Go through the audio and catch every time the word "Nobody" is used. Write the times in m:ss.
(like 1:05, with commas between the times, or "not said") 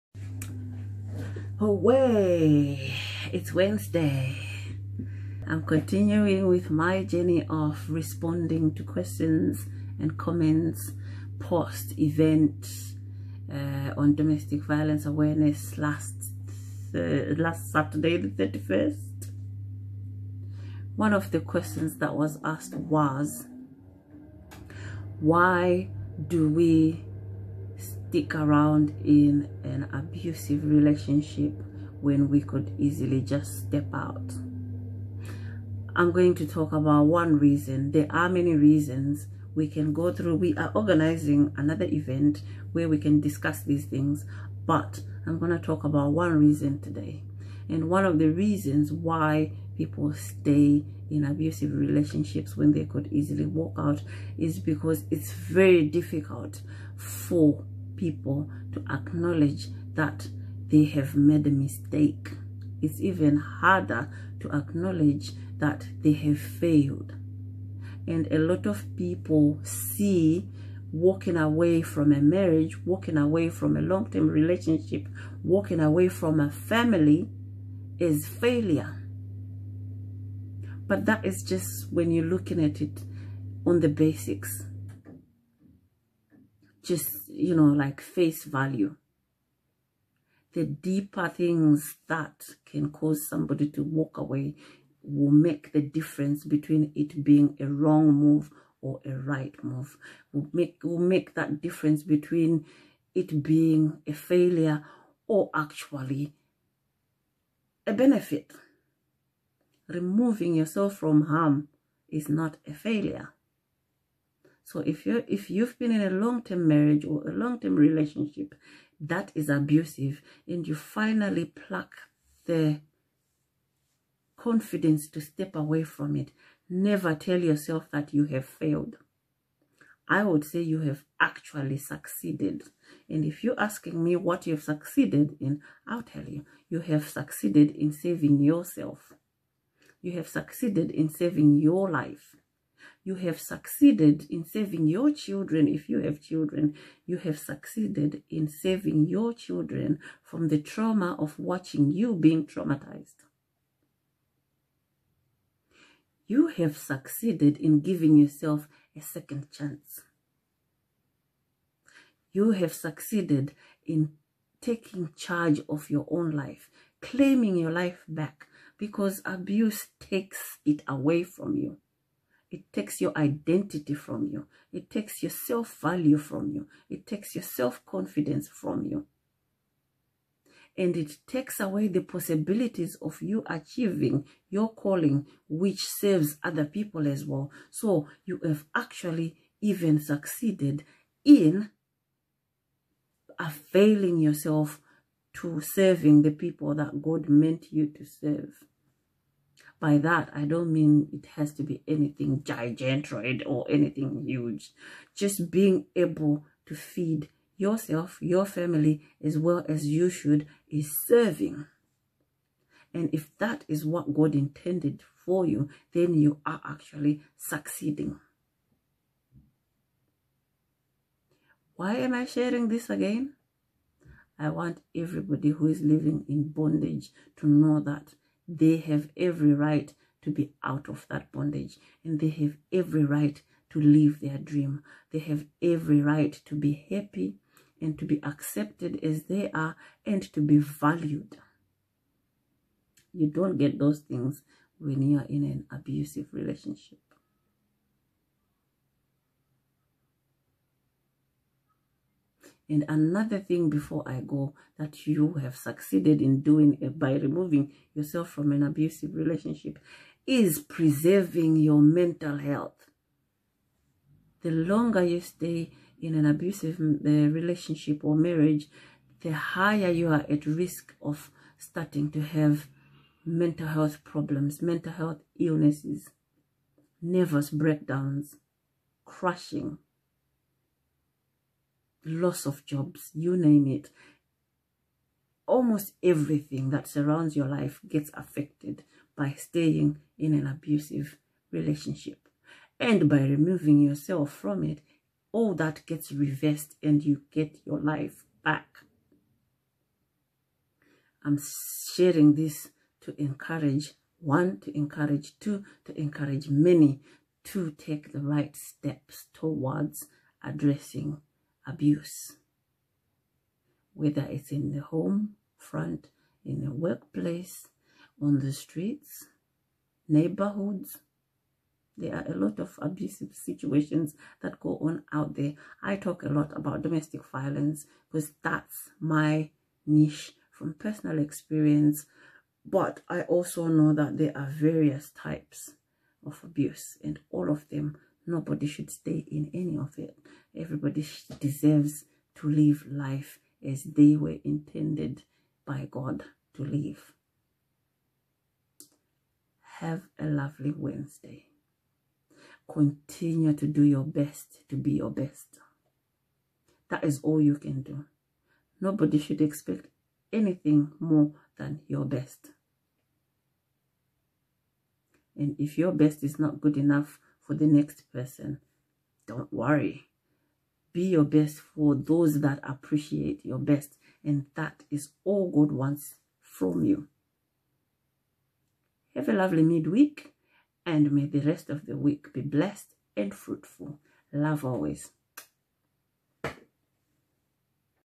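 5:38, 5:58.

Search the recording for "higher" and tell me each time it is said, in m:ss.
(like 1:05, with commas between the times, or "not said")
4:29.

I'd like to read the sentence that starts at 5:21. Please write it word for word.
There are a lot of abusive situations that go on out there.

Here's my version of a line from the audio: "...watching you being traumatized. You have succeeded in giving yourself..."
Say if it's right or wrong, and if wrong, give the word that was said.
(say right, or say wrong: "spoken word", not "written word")
right.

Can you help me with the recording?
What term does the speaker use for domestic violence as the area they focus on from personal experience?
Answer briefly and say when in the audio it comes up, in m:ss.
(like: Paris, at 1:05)
niche, at 5:29.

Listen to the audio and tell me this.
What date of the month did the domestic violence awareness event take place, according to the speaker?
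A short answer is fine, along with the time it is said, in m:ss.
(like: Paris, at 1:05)
31st, at 0:18.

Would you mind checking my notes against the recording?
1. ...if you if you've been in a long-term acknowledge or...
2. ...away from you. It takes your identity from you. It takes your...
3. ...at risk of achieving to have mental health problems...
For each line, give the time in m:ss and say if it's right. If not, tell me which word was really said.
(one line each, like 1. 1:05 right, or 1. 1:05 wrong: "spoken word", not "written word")
1. 1:54 wrong: "marriage", not "acknowledge"
2. 2:50 right
3. 4:30 wrong: "starting", not "achieving".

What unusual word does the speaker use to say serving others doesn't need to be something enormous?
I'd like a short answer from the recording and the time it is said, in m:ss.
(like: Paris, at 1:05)
gigantroid, at 3:22.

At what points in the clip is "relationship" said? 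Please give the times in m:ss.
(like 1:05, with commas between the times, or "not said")
0:30, 0:51, 1:14, 1:57, 4:06, 4:19, 4:27, 4:51.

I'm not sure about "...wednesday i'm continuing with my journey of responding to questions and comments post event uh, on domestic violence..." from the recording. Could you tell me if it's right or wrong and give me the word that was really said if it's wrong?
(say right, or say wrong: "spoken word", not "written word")
right.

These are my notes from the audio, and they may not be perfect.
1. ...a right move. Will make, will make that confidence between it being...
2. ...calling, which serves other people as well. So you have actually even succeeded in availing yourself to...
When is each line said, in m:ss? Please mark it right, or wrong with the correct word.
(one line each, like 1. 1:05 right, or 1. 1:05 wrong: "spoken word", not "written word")
1. 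1:39 wrong: "difference", not "confidence"
2. 3:04 right.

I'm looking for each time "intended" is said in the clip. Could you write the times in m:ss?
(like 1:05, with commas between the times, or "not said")
3:34, 5:44.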